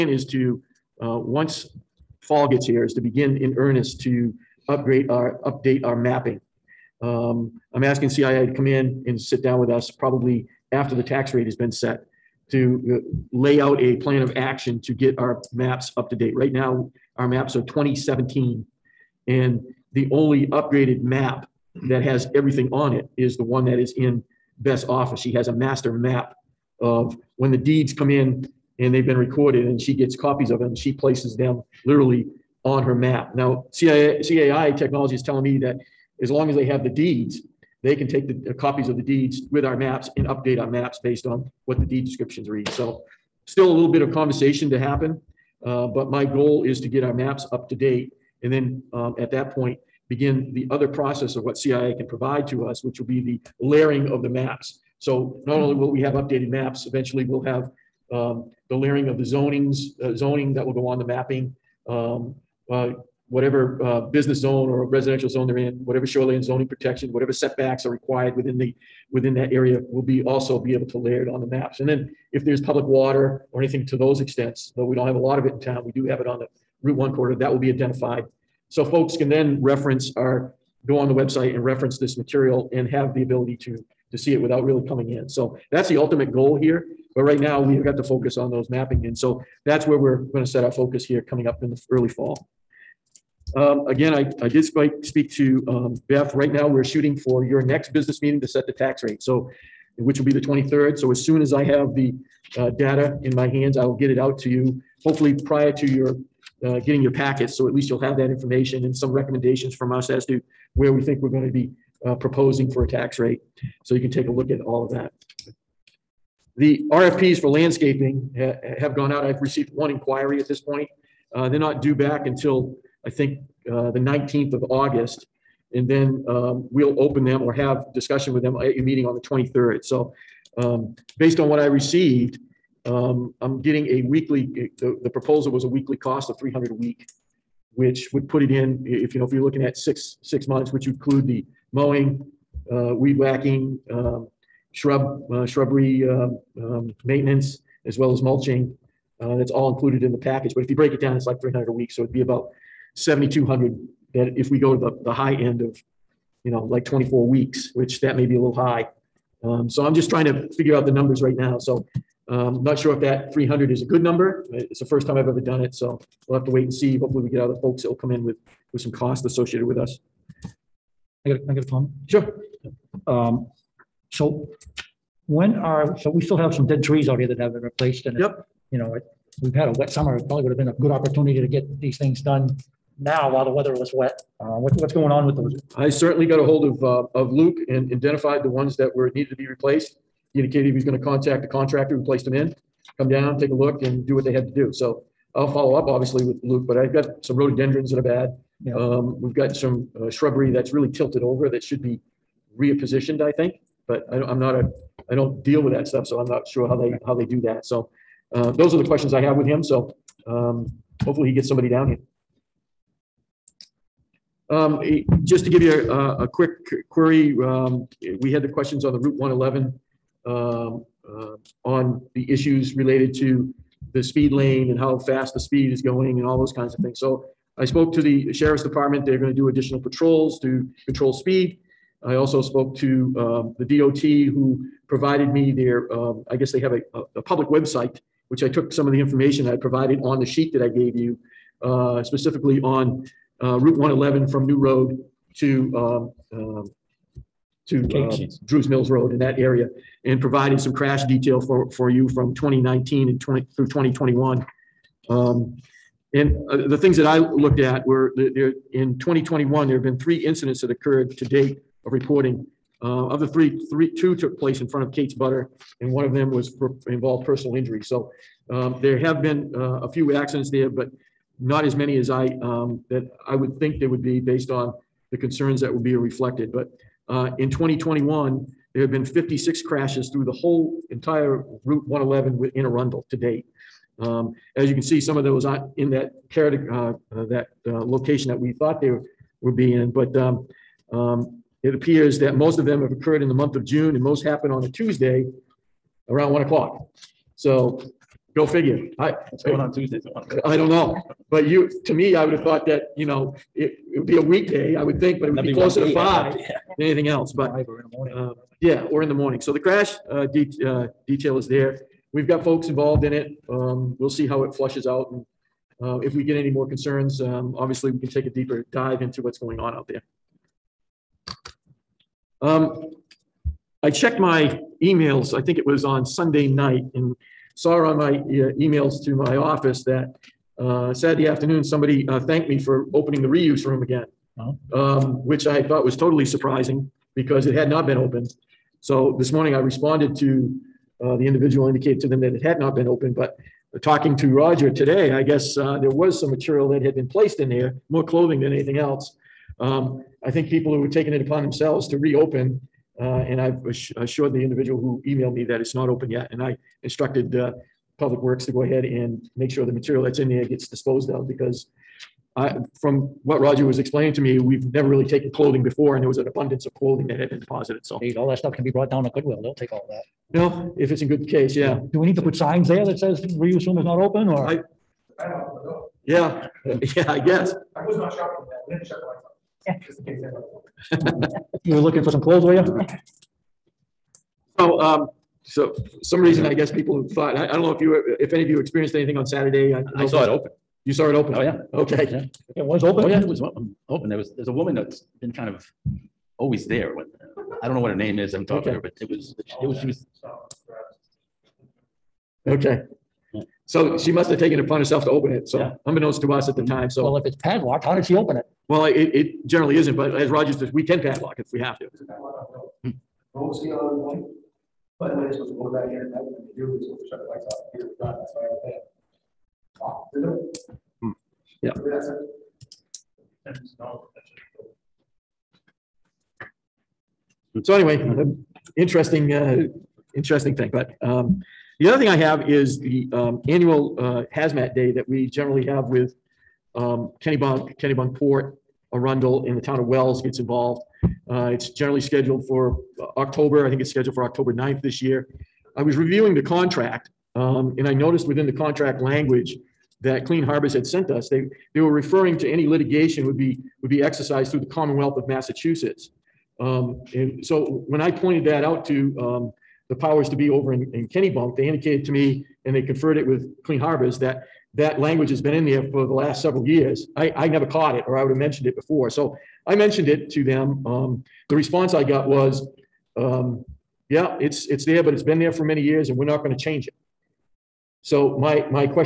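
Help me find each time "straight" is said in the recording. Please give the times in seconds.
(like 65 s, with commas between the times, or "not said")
not said.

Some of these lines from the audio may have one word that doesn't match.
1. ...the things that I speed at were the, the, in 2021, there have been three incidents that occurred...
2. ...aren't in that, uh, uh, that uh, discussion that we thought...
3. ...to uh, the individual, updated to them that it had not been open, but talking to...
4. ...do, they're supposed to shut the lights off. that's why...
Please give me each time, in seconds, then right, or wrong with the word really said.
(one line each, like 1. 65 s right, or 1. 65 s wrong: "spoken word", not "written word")
1. 256 s wrong: "looked", not "speed"
2. 285 s wrong: "location", not "discussion"
3. 340 s wrong: "indicated", not "updated"
4. 416 s right.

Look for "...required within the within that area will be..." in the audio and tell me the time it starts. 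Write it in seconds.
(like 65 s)
67 s.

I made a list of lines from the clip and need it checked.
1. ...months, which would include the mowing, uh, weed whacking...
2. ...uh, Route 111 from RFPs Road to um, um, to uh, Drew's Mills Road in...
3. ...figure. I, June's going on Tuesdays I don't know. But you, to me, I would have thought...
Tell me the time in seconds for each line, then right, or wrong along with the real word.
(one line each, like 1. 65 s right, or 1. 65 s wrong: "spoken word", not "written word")
1. 140 s right
2. 243 s wrong: "New", not "RFPs"
3. 298 s wrong: "What", not "June".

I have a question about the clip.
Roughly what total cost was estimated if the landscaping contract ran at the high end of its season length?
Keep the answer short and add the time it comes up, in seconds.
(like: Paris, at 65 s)
7,200, at 152 s.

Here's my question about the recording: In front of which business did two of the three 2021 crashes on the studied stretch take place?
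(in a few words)
Kate's Butter.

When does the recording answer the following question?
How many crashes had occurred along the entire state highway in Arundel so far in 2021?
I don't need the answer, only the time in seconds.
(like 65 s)
279 s.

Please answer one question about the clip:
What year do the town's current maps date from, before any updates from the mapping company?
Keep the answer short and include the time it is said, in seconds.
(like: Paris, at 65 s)
2017, at 17 s.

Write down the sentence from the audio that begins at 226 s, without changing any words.
So I spoke to the sheriff's department.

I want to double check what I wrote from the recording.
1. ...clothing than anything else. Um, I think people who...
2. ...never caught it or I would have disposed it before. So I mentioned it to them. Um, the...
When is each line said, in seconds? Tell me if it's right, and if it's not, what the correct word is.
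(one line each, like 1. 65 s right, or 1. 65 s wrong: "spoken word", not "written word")
1. 348 s right
2. 467 s wrong: "mentioned", not "disposed".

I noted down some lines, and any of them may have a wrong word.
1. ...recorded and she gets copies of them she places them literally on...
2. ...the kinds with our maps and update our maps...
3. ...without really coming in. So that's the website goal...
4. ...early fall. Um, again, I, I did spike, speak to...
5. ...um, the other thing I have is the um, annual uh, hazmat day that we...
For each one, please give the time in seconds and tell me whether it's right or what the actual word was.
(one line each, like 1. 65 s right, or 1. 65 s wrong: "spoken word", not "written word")
1. 29 s right
2. 38 s wrong: "deeds", not "kinds"
3. 84 s wrong: "ultimate", not "website"
4. 91 s right
5. 431 s right.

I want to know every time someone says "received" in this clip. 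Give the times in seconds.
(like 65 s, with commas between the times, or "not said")
119 s, 131 s.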